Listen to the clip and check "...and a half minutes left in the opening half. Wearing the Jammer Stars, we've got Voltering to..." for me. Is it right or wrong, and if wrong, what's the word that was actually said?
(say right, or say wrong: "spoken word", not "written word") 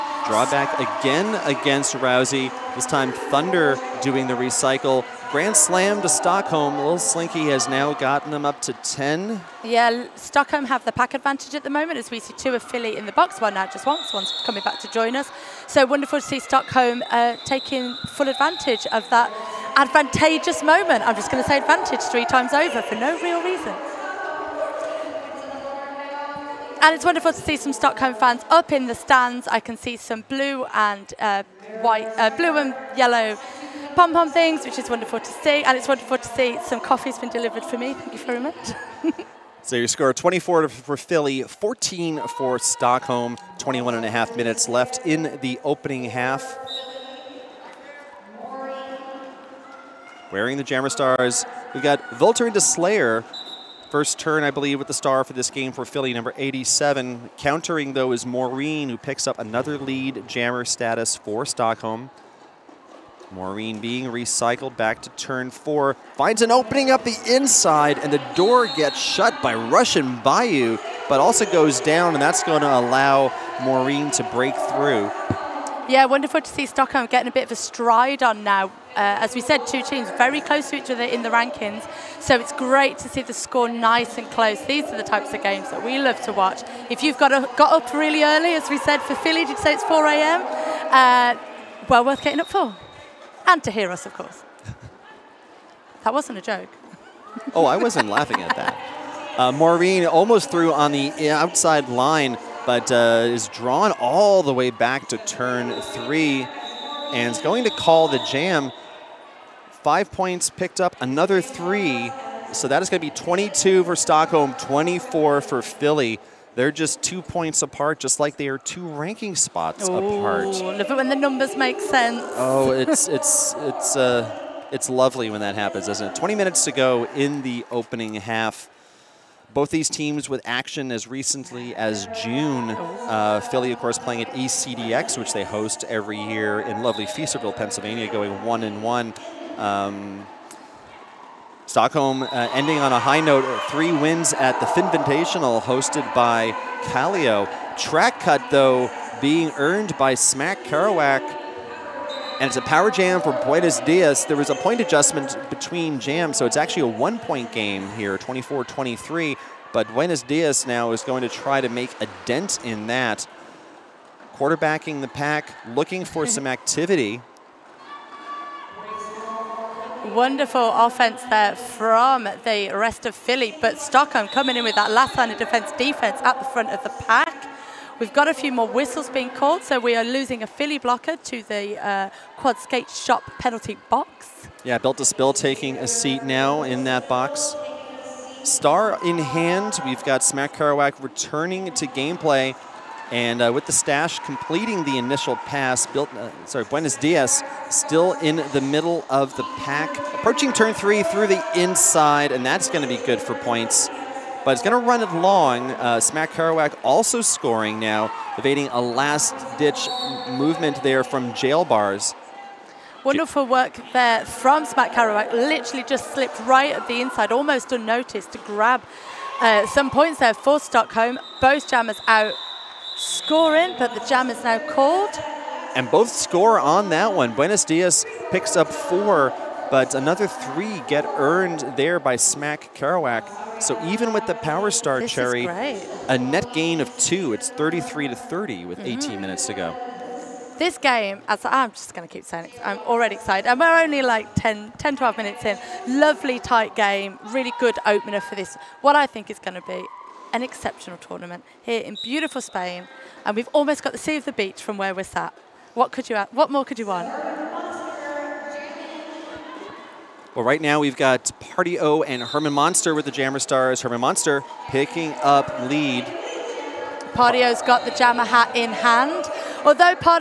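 right.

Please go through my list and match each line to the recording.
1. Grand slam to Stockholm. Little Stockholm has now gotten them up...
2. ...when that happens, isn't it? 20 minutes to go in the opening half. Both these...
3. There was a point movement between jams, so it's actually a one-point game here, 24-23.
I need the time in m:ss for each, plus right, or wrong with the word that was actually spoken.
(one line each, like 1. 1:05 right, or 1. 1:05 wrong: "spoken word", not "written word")
1. 0:05 wrong: "Slinky", not "Stockholm"
2. 2:05 right
3. 2:34 wrong: "adjustment", not "movement".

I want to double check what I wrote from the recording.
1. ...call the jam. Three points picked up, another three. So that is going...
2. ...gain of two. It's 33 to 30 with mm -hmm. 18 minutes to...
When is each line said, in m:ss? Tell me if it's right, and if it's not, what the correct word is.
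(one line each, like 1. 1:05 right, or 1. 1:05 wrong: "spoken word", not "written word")
1. 1:47 wrong: "Five", not "Three"
2. 3:56 right.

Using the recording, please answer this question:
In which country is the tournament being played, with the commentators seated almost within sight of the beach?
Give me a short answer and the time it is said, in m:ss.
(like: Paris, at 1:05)
Spain, at 4:12.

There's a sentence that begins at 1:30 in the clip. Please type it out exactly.
Uh, well worth getting up for.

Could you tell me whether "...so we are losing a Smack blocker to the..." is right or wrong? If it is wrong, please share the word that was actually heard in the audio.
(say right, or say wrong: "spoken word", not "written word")
wrong: "Philly", not "Smack".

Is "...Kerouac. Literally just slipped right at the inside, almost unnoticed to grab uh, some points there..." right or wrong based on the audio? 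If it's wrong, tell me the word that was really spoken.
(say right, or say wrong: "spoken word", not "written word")
right.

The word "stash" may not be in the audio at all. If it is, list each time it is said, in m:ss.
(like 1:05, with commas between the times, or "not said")
3:13.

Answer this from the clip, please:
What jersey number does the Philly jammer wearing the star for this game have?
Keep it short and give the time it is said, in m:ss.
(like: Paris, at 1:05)
87, at 0:56.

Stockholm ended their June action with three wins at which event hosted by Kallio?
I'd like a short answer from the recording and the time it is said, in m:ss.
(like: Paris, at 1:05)
Finventational, at 2:24.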